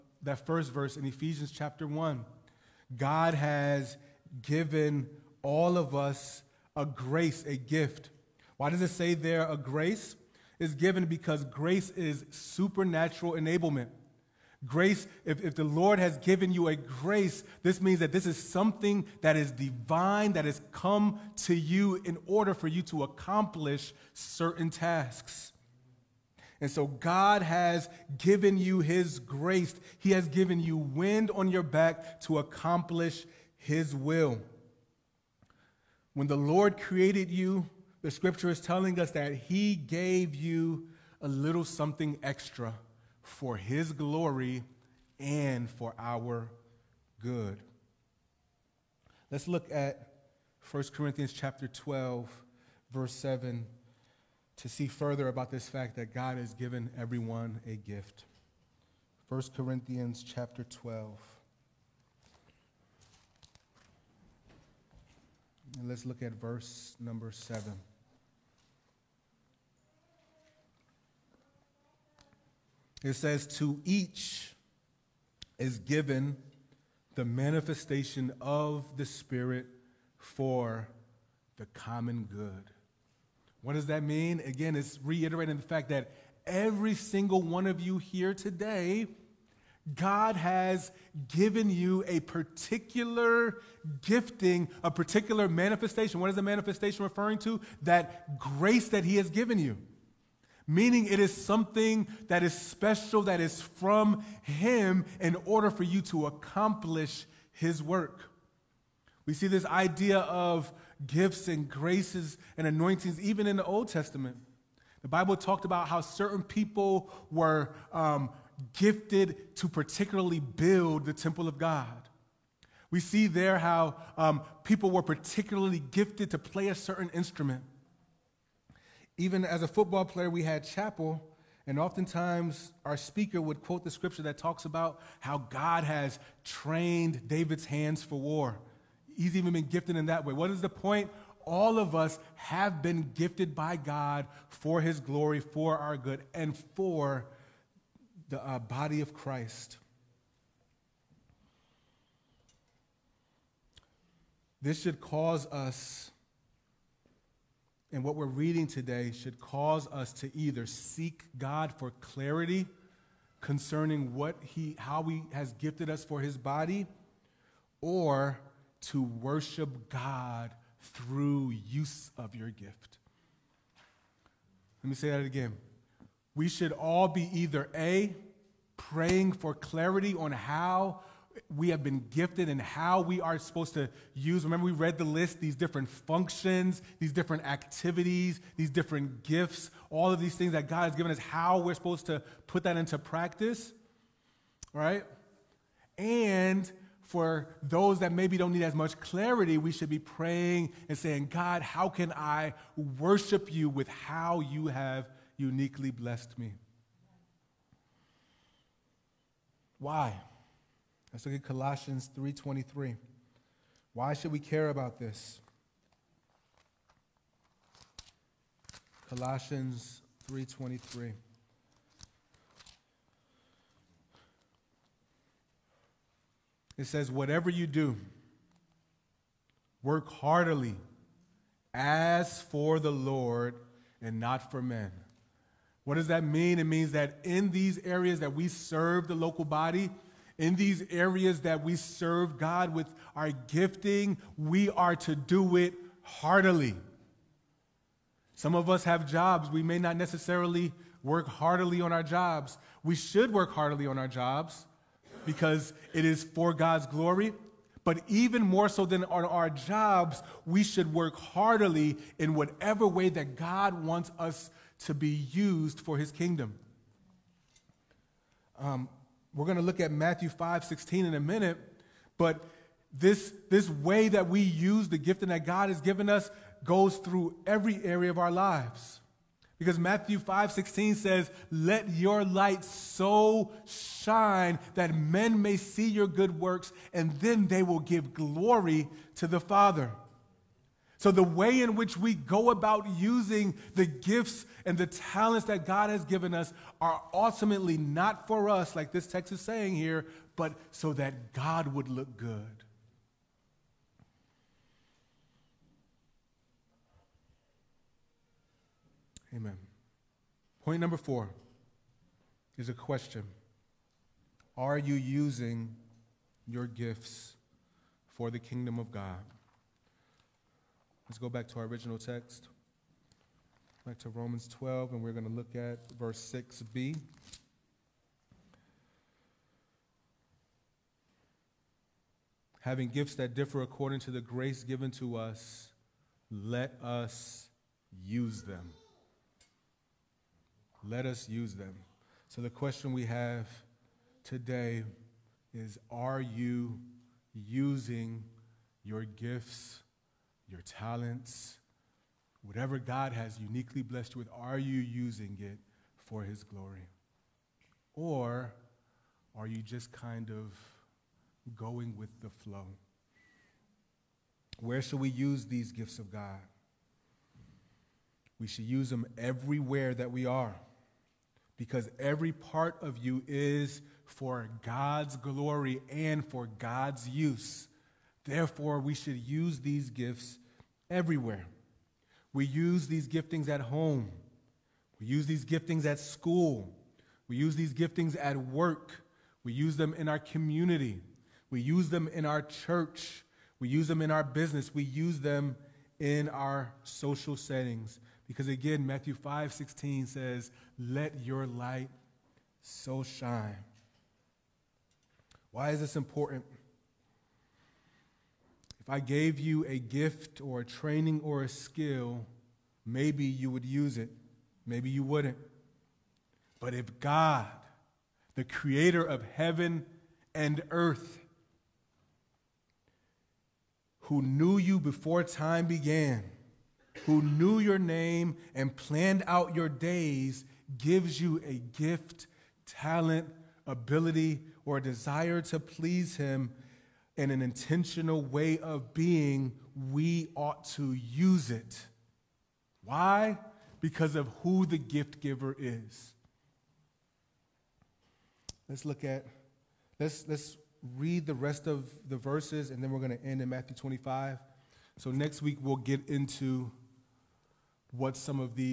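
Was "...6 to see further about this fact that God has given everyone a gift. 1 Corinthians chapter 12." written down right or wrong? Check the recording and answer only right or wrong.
wrong.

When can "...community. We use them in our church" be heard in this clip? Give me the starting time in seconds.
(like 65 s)
390 s.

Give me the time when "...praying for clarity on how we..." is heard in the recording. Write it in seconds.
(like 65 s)
178 s.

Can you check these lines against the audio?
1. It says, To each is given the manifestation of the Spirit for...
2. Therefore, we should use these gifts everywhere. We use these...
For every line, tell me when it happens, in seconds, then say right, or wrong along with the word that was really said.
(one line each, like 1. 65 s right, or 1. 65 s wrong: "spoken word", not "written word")
1. 73 s right
2. 378 s right.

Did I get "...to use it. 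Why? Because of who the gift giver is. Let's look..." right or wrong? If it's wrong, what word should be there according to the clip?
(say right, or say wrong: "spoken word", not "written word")
right.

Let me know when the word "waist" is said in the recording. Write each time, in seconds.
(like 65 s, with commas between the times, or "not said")
not said.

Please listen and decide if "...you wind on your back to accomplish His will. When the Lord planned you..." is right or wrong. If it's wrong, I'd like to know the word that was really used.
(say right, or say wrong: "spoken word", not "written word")
wrong: "created", not "planned".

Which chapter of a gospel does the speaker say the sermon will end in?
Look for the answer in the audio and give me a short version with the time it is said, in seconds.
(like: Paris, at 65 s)
Matthew 25, at 453 s.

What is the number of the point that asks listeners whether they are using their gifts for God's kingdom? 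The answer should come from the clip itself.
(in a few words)
4.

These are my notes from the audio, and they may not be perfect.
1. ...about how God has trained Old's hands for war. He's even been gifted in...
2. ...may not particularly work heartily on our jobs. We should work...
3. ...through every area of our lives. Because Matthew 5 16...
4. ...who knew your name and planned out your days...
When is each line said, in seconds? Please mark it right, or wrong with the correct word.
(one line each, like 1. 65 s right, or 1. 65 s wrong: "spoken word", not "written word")
1. 134 s wrong: "David", not "Old"
2. 249 s wrong: "necessarily", not "particularly"
3. 276 s right
4. 427 s right.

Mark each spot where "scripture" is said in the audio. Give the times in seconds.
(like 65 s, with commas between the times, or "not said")
38 s, 133 s.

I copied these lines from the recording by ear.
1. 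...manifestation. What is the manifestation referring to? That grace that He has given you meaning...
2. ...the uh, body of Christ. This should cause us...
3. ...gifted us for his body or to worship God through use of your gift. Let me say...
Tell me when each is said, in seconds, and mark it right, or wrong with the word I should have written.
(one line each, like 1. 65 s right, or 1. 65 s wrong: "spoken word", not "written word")
1. 95 s right
2. 148 s right
3. 165 s right.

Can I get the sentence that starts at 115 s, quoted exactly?
The Bible talked about how certain people were um, gifted to particularly build the temple of God.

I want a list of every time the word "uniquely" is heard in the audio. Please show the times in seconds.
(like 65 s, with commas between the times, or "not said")
205 s, 353 s.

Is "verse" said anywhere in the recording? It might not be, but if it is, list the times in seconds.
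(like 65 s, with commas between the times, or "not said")
0 s, 52 s, 66 s, 325 s, 452 s.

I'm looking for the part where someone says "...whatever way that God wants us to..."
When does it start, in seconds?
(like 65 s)
262 s.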